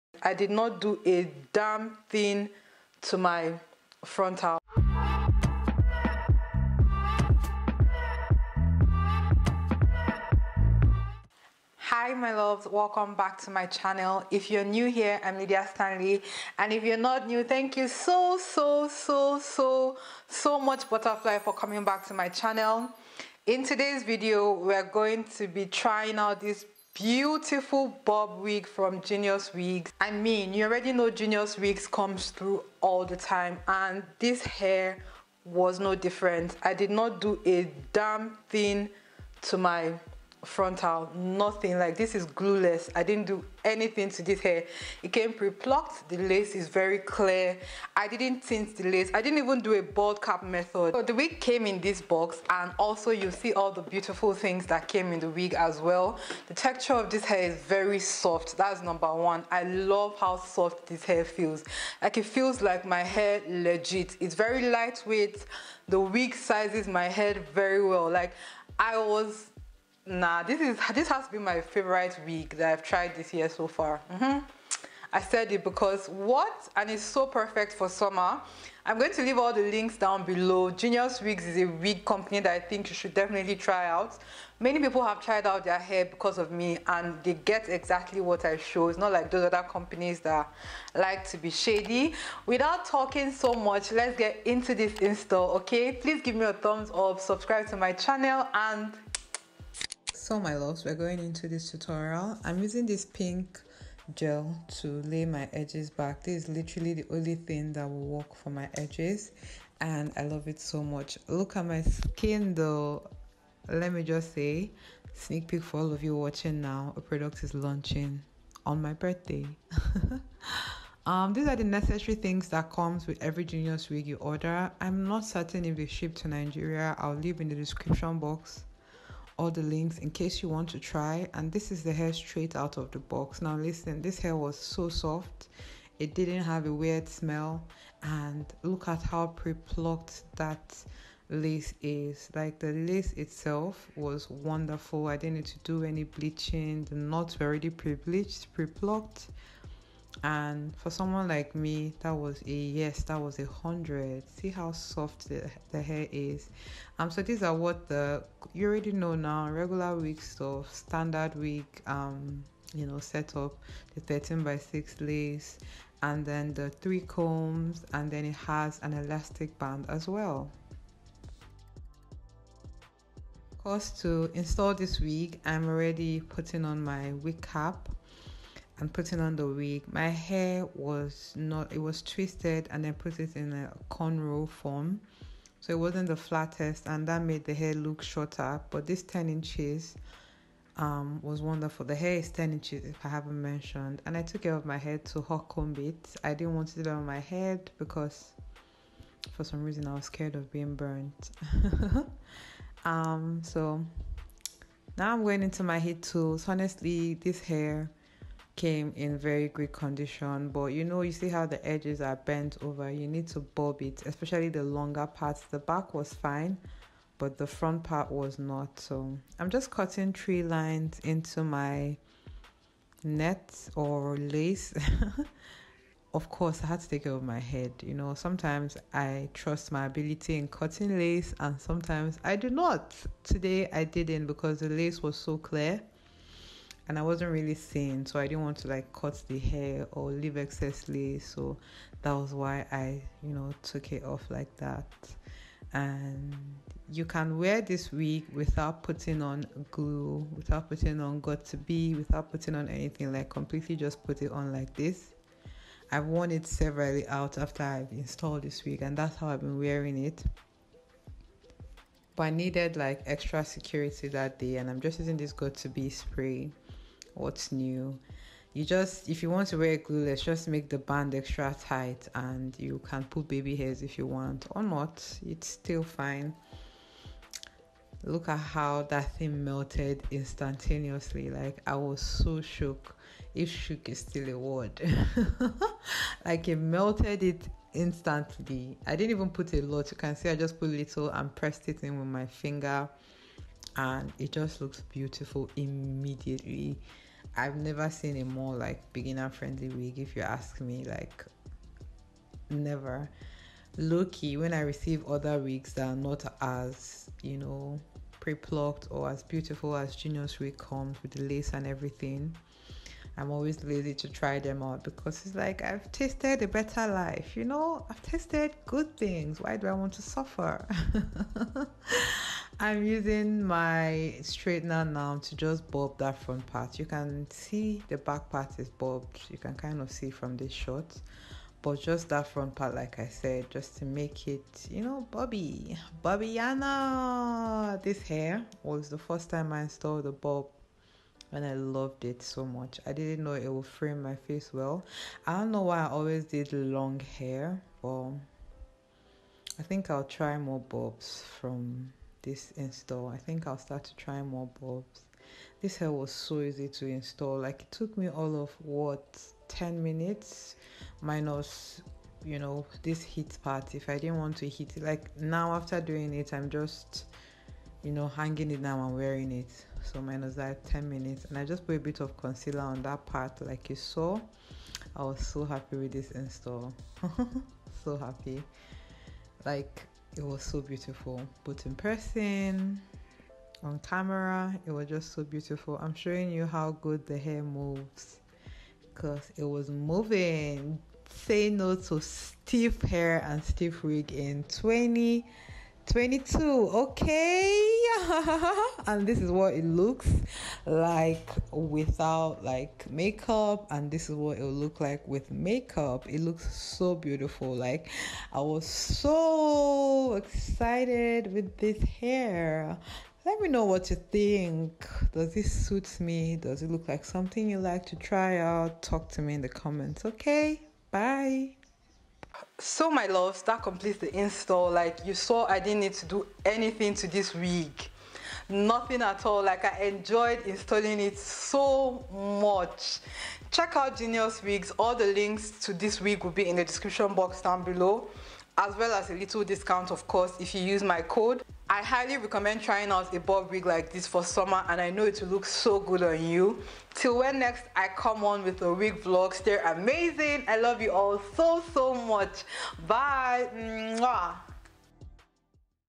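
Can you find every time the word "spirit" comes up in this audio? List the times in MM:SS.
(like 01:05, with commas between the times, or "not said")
not said.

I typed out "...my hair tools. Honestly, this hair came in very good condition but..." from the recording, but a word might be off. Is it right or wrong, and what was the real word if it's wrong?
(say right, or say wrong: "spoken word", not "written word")
right.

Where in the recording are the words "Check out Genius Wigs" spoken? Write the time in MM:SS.
07:13.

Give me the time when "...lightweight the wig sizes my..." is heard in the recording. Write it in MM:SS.
01:04.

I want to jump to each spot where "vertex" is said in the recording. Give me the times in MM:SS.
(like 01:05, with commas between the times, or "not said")
not said.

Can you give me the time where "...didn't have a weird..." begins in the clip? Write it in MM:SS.
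02:16.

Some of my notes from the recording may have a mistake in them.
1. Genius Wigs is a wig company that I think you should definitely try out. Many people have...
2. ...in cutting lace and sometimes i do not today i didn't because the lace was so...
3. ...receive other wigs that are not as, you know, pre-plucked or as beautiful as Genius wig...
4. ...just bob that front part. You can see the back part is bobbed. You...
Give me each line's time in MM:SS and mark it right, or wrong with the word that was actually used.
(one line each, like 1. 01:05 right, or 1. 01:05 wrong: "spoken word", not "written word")
1. 01:20 right
2. 03:50 right
3. 05:04 right
4. 05:25 right.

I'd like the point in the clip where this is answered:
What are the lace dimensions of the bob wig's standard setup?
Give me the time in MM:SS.
02:44.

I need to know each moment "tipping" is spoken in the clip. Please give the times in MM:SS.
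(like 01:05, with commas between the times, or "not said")
not said.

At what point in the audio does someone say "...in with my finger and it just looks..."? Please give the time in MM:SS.
04:51.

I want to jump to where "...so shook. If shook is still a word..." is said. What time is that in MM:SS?
04:42.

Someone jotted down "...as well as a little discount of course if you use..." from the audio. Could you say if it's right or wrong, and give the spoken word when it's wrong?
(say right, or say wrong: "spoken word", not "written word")
right.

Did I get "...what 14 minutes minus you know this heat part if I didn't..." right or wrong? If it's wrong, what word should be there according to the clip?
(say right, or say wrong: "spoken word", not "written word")
wrong: "10", not "14".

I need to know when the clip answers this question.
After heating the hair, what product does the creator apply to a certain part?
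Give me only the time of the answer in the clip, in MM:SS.
06:12.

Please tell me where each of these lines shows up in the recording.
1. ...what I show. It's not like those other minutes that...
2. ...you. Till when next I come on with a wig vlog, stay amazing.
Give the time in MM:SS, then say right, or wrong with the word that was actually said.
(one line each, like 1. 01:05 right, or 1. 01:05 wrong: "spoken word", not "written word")
1. 01:28 wrong: "companies", not "minutes"
2. 07:26 right.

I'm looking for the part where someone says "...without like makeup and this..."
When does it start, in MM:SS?
06:41.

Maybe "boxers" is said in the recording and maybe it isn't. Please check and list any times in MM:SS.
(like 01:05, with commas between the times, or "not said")
not said.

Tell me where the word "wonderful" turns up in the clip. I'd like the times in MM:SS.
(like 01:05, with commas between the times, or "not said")
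02:24, 03:11.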